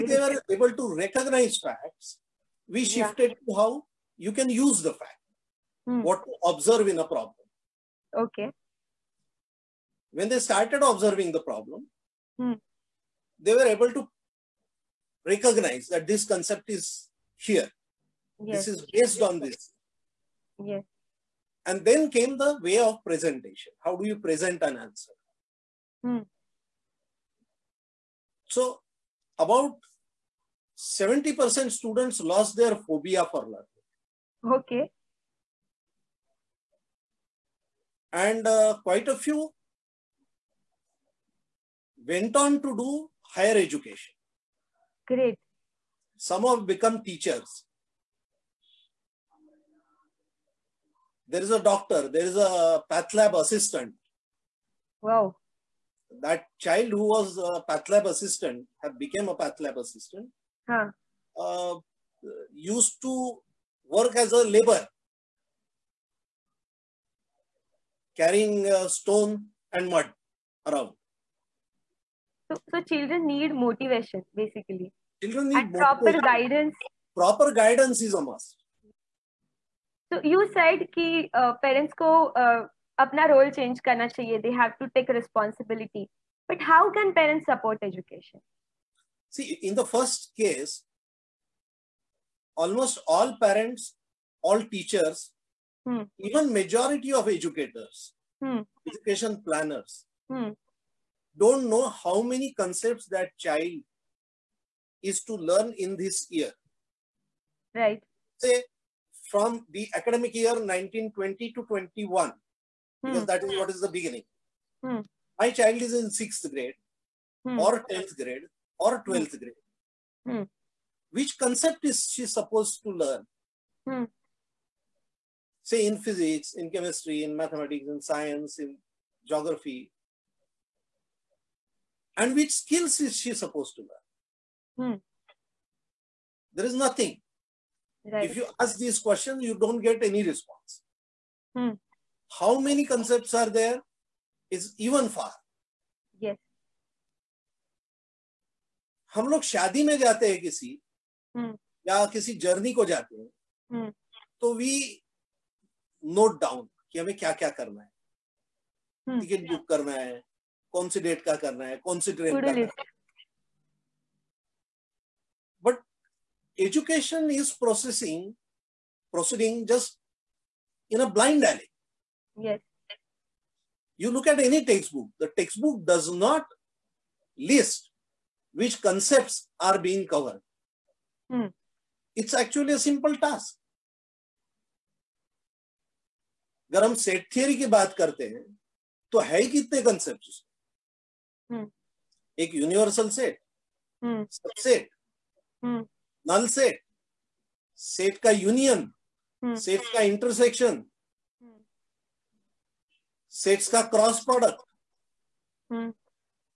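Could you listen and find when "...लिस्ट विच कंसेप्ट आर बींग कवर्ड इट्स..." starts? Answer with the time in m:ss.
2:57.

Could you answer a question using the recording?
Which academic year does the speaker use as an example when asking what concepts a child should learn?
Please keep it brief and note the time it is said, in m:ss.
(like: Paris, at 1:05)
1920 to 21, at 1:50.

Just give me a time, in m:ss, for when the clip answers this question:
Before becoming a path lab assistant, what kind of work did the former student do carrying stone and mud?
1:04.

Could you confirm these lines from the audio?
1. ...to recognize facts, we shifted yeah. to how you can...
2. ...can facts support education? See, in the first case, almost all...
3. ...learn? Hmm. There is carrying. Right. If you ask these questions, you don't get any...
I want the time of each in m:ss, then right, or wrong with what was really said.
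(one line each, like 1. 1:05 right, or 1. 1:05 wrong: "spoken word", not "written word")
1. 0:00 right
2. 1:26 wrong: "parents", not "facts"
3. 2:13 wrong: "nothing", not "carrying".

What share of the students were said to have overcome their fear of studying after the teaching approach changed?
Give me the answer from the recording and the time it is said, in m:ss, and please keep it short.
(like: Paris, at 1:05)
70%, at 0:30.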